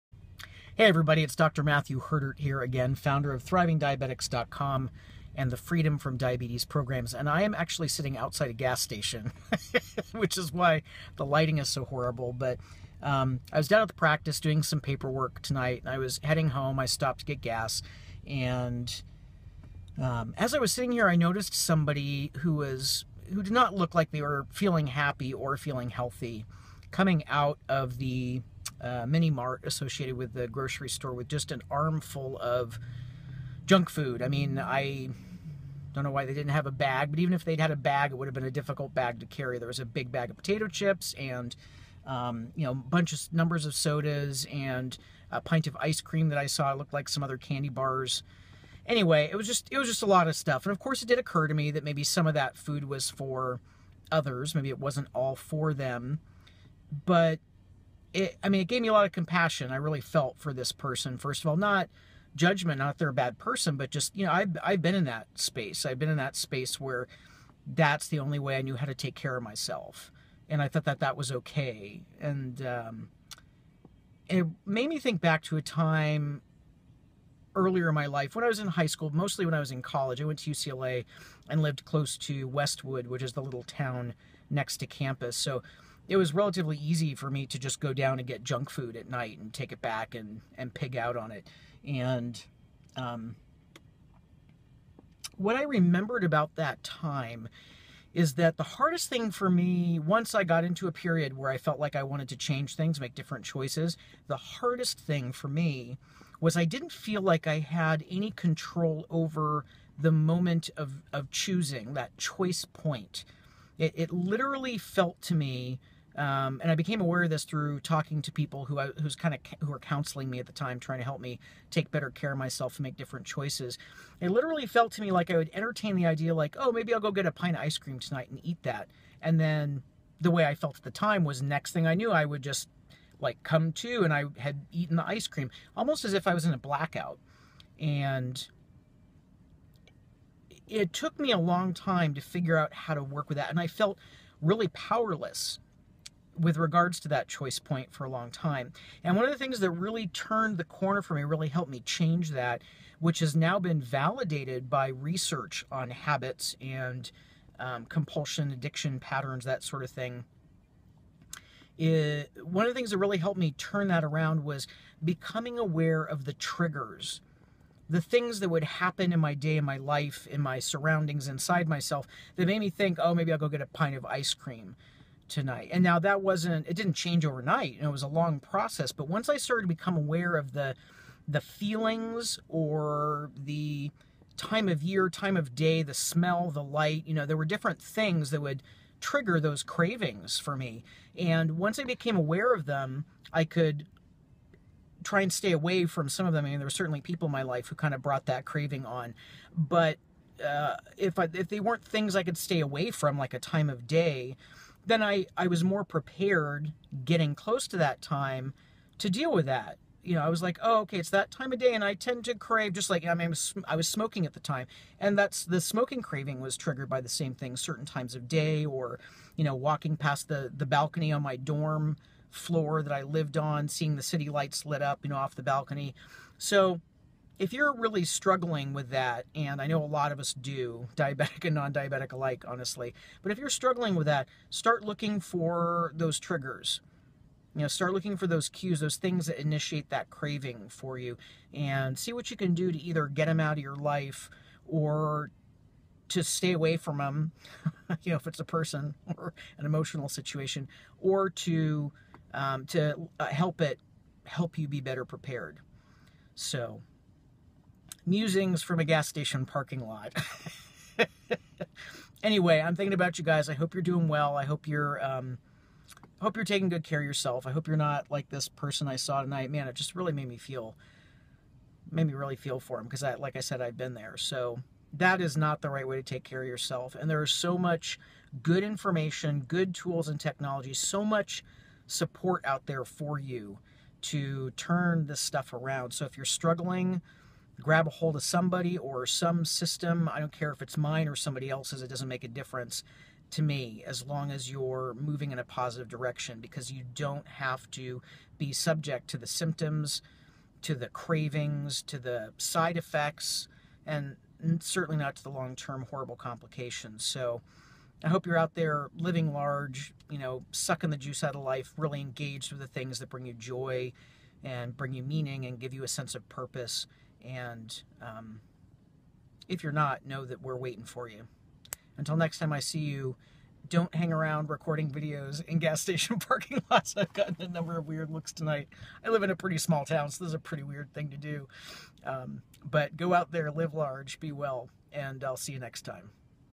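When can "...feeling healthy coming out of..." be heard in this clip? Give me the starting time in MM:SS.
00:25.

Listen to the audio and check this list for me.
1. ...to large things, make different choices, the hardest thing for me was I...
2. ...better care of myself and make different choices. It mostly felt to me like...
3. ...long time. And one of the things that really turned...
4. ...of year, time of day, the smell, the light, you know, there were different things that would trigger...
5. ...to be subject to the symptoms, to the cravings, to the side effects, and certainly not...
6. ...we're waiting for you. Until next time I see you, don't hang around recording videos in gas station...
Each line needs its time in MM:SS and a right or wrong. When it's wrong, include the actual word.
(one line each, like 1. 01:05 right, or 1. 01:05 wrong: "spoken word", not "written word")
1. 01:42 wrong: "change", not "large"
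2. 02:01 wrong: "literally", not "mostly"
3. 02:28 right
4. 03:04 right
5. 04:57 right
6. 05:20 right.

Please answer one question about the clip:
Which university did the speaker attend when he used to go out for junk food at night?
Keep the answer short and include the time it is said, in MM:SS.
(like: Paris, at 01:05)
UCLA, at 01:20.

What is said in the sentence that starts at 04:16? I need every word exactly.
So, musings from a gas station parking lot.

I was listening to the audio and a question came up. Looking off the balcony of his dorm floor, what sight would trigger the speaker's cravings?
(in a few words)
City lights.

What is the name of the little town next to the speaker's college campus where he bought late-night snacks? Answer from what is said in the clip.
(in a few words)
Westwood.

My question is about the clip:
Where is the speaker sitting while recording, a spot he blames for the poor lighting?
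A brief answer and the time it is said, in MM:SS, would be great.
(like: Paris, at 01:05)
Outside a gas station, at 00:08.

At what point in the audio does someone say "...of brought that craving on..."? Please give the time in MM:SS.
03:17.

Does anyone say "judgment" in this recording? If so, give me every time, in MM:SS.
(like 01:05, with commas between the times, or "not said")
01:02.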